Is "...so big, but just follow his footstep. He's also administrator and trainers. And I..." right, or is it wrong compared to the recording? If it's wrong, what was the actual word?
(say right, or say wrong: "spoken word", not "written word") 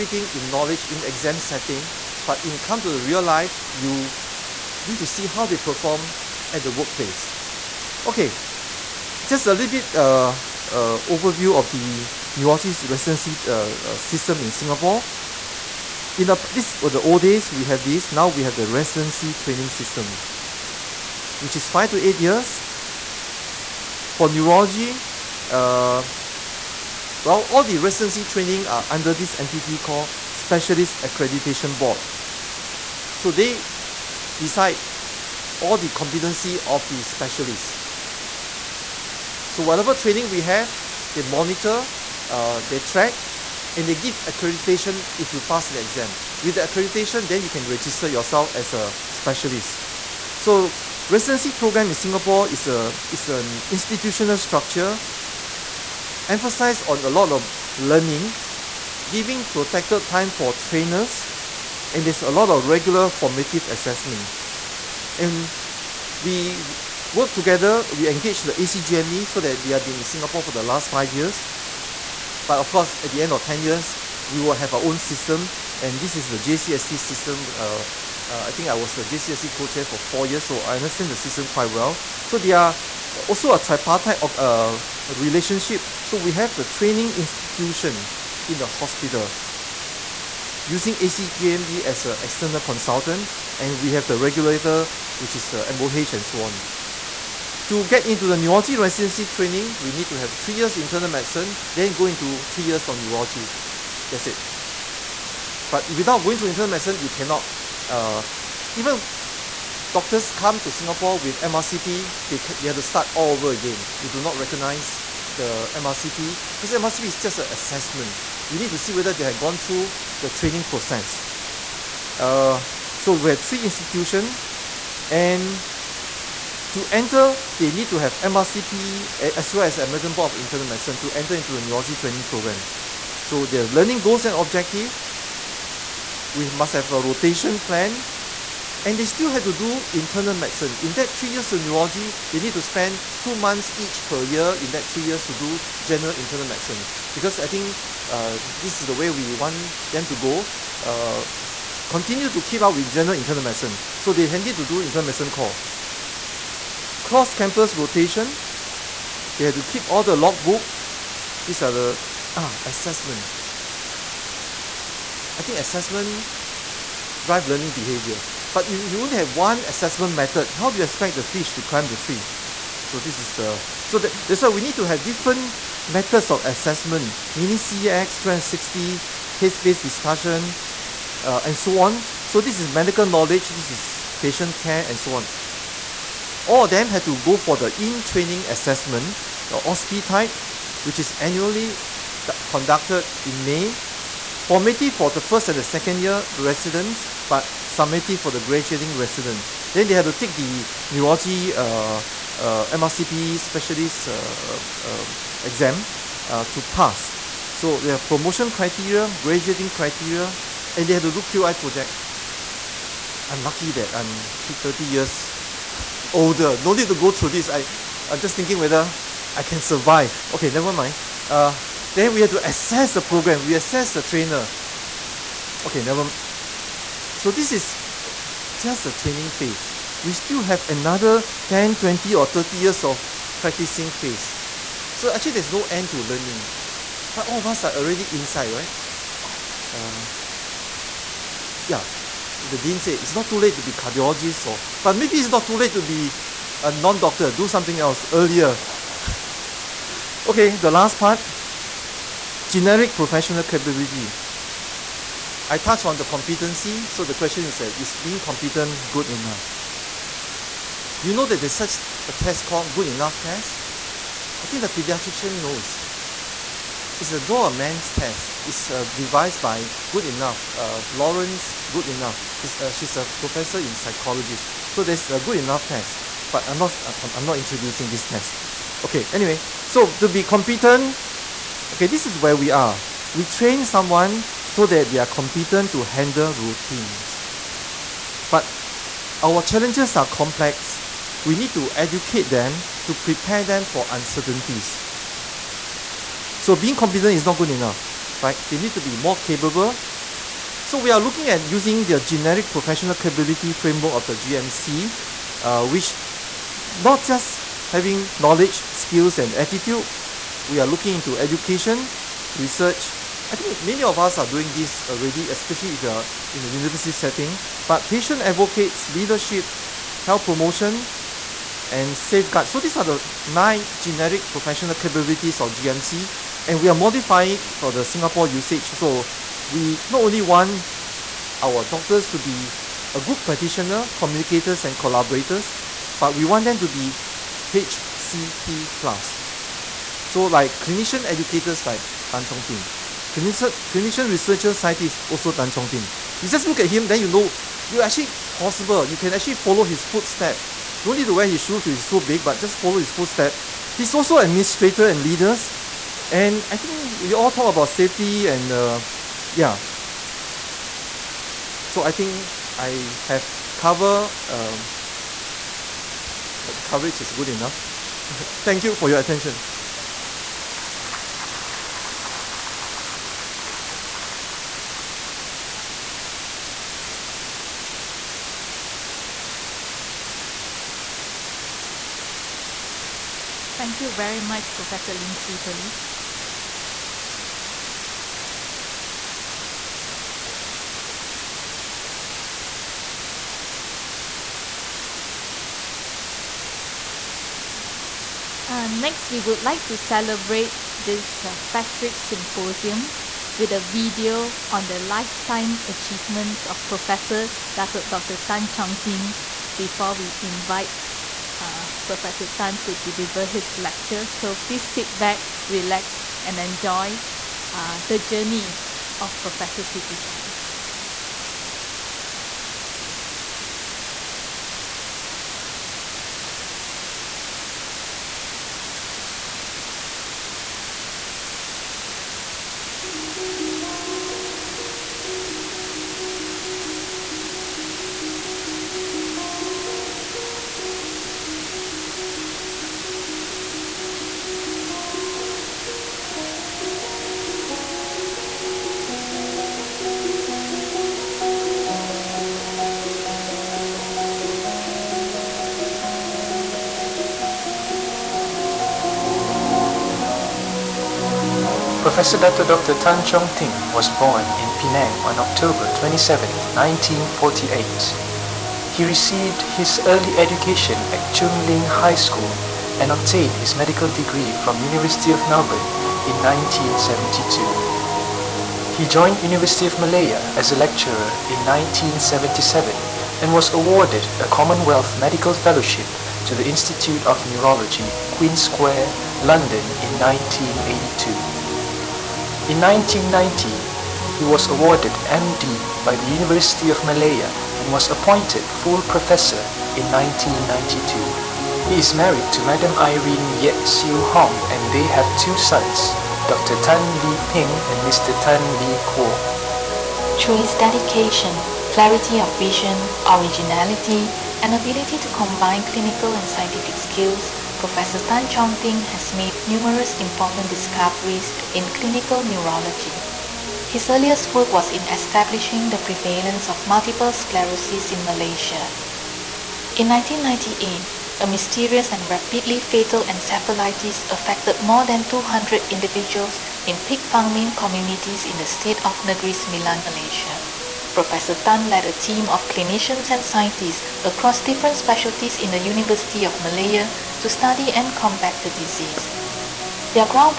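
wrong: "leaders", not "trainers".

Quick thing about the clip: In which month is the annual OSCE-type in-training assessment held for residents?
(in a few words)
May.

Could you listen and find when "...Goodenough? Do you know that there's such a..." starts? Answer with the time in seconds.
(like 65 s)
258 s.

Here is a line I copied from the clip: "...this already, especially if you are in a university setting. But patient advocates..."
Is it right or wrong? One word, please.
right.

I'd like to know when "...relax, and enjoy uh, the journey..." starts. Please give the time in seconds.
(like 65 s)
415 s.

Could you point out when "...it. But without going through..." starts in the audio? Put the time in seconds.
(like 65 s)
104 s.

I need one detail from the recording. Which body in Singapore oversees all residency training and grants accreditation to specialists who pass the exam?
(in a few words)
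Specialist Accreditation Board.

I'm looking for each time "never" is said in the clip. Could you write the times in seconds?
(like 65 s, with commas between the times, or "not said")
220 s, 225 s.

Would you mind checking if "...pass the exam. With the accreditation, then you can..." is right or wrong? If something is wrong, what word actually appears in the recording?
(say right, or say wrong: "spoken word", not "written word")
right.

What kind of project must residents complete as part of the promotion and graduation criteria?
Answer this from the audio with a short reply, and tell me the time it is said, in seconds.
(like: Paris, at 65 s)
QI project, at 211 s.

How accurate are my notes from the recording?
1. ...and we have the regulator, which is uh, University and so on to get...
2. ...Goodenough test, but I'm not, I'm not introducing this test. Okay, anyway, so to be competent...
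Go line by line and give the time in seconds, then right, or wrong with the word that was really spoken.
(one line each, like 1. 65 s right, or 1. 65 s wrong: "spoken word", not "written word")
1. 93 s wrong: "MOH", not "University"
2. 275 s right.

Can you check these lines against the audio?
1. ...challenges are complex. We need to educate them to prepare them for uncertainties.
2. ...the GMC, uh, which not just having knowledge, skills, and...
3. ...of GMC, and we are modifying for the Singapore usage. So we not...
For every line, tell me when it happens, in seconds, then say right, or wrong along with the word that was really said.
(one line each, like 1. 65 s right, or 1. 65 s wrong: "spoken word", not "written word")
1. 289 s right
2. 304 s right
3. 325 s right.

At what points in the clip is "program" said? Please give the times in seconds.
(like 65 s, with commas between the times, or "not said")
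51 s, 132 s, 223 s.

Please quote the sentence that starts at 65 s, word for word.
And we work together, we engage the ACGME so that they have been in Singapore for the last five years.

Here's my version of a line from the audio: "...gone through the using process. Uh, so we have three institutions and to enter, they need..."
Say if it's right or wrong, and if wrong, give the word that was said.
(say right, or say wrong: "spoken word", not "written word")
wrong: "training", not "using".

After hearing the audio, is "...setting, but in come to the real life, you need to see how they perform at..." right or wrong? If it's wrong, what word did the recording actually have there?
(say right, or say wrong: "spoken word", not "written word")
right.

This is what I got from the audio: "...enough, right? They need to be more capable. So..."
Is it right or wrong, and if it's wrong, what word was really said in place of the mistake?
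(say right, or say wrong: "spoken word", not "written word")
right.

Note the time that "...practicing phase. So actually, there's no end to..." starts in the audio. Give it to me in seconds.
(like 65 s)
233 s.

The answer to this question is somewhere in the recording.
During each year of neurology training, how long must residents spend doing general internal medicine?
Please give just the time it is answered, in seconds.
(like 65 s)
143 s.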